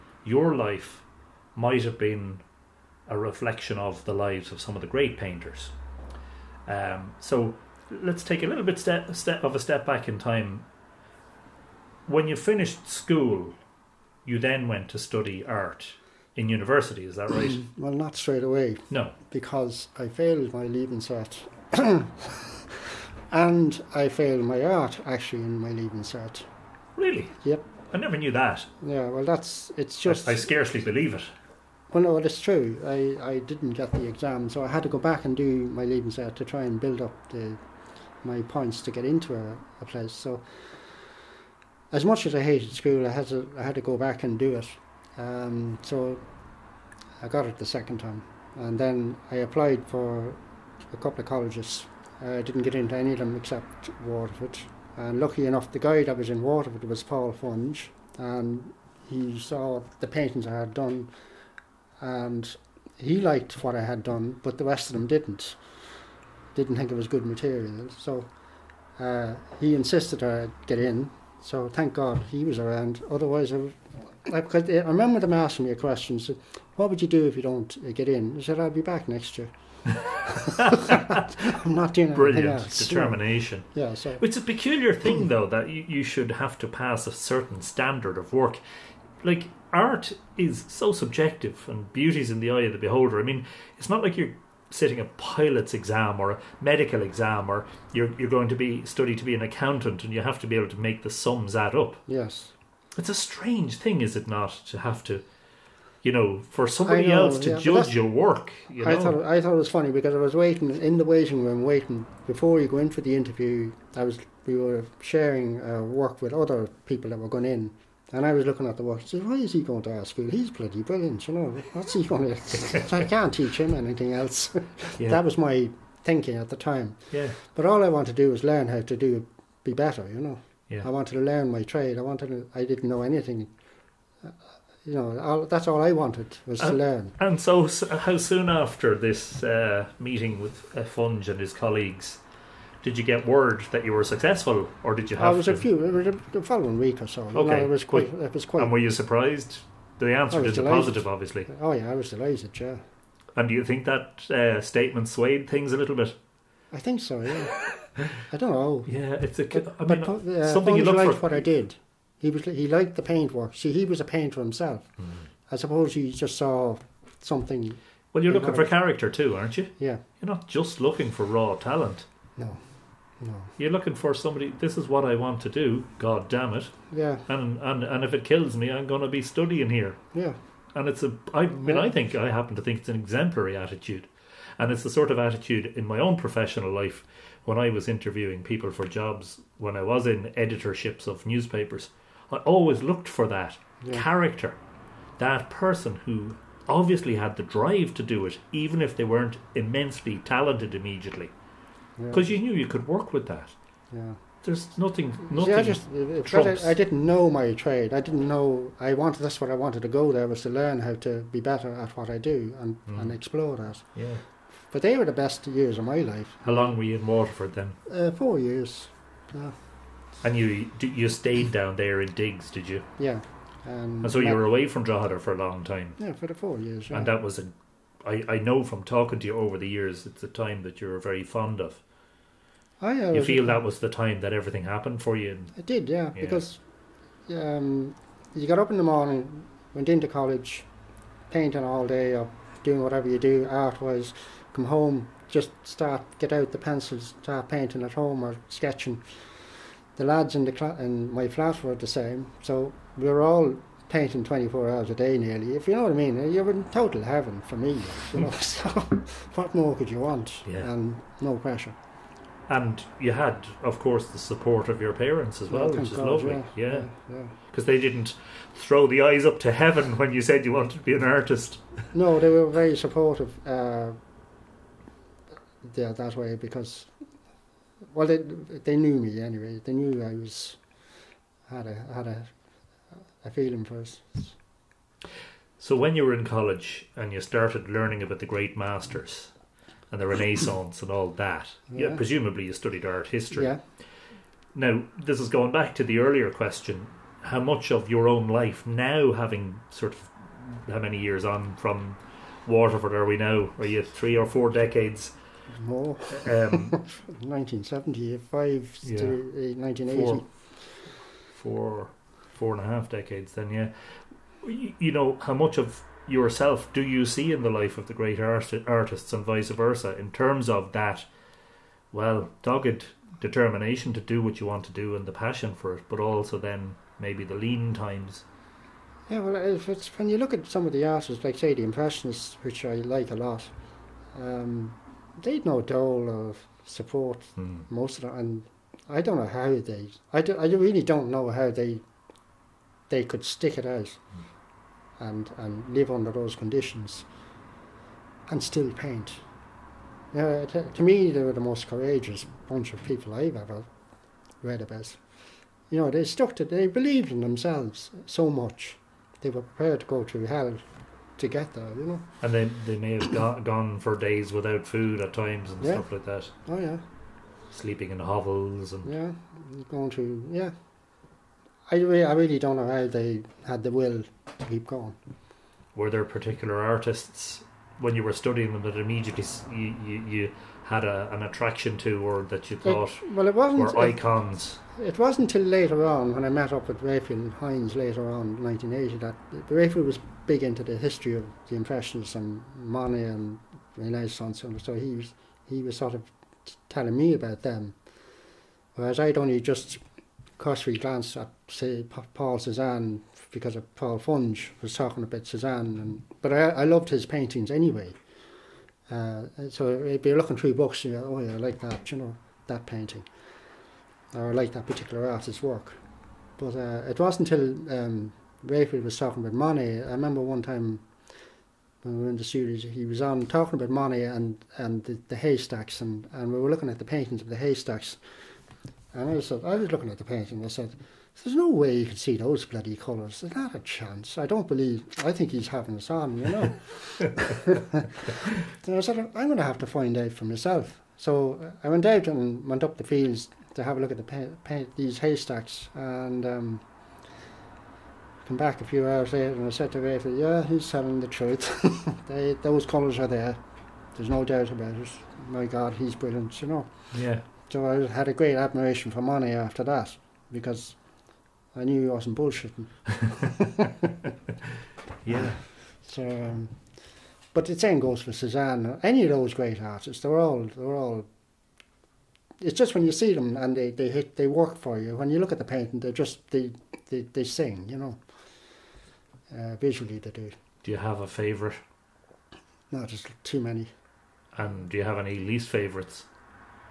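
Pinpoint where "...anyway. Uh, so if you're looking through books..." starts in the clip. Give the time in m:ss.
6:47.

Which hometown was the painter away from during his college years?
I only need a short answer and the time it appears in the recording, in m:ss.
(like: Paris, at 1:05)
Drogheda, at 3:44.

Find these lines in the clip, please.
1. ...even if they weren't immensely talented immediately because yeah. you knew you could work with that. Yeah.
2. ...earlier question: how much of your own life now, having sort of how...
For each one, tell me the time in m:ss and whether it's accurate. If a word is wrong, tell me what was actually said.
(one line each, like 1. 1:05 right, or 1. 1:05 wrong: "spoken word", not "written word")
1. 3:18 right
2. 4:55 right.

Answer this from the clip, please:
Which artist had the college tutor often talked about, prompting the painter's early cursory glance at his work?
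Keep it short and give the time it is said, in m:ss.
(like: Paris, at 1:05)
Paul Cezanne, at 6:42.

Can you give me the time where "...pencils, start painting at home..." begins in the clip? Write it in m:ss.
4:06.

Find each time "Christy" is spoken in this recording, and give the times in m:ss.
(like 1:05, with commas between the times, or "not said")
not said.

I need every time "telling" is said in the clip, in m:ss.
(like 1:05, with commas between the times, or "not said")
6:36, 7:30.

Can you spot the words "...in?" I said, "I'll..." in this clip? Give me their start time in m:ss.
1:18.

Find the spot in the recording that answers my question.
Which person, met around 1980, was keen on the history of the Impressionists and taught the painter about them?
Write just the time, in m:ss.
6:26.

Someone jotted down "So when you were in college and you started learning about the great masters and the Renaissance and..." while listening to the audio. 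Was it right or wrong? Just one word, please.
right.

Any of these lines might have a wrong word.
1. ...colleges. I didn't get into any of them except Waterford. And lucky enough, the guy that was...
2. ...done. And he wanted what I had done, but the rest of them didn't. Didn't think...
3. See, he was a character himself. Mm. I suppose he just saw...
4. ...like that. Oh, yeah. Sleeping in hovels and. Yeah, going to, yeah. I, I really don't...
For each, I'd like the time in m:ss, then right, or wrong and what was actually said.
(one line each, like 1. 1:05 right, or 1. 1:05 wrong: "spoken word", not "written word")
1. 0:51 right
2. 1:00 wrong: "liked", not "wanted"
3. 2:43 wrong: "painter", not "character"
4. 6:05 right.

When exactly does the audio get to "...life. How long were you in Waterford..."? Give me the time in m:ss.
3:35.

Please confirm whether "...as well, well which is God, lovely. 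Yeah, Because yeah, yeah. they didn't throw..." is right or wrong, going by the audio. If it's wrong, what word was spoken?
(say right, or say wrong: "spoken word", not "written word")
right.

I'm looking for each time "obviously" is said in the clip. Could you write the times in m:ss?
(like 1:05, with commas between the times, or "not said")
2:31, 3:16.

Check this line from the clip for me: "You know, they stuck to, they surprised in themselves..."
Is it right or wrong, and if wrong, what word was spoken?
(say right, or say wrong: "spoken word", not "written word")
wrong: "believed", not "surprised".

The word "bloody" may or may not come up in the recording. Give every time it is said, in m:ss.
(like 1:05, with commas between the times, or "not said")
2:00, 7:12.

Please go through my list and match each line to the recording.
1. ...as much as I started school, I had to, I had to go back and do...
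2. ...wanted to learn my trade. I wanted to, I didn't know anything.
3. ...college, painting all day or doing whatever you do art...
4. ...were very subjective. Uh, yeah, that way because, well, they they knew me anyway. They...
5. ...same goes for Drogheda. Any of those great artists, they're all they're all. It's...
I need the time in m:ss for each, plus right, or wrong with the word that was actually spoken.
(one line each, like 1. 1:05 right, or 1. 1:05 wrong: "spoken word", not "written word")
1. 0:41 wrong: "hated", not "started"
2. 2:10 right
3. 4:00 right
4. 4:32 wrong: "supportive", not "subjective"
5. 7:47 wrong: "Cezanne", not "Drogheda".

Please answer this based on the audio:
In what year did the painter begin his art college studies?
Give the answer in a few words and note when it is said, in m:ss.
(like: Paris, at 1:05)
1975, at 5:07.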